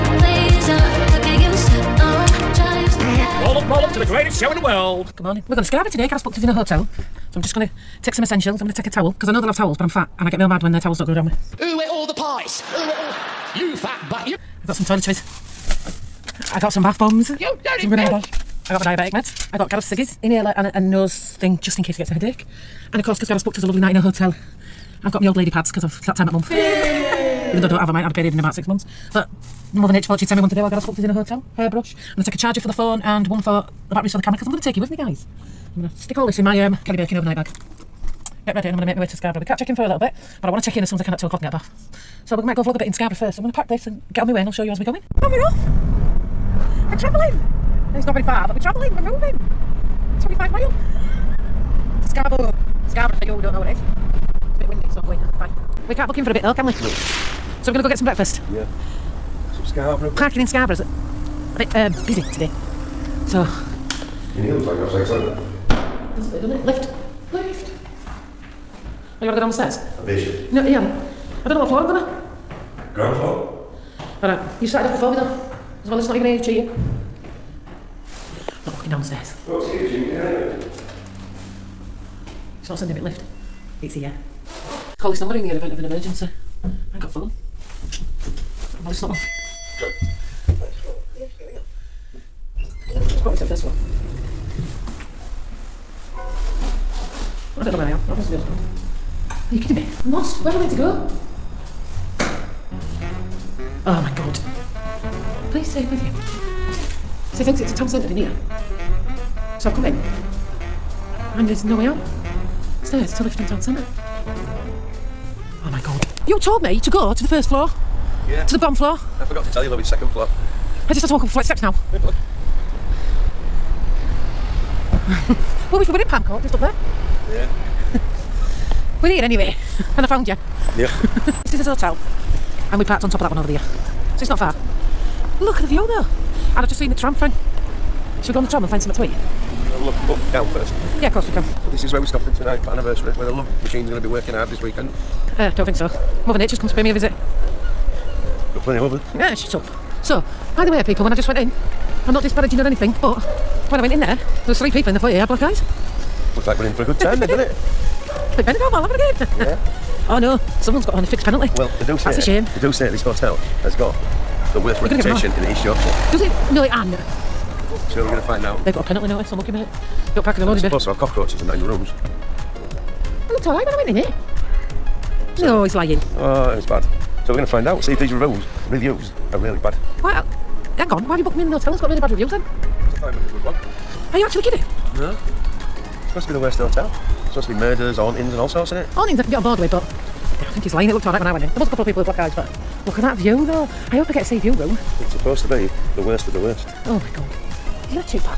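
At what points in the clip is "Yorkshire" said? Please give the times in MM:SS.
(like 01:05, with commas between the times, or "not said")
02:45.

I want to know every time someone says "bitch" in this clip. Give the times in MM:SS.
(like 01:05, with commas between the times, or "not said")
00:17.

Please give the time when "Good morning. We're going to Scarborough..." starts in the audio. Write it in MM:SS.
00:05.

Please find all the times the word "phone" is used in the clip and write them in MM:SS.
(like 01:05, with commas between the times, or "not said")
00:32, 01:27.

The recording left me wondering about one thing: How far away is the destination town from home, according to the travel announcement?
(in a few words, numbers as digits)
25 miles.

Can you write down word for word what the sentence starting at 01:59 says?
I forgot to tell you, love, it's second floor.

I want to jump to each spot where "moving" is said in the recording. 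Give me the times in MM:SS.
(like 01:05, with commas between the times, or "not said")
00:49, 01:29.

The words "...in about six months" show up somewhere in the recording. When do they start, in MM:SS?
00:28.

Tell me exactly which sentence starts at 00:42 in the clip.
So we might go vlog a bit in Scarborough first.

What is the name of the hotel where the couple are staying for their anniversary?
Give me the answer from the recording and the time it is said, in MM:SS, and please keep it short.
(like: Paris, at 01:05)
Palm Court, at 02:06.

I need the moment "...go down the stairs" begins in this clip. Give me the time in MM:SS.
01:09.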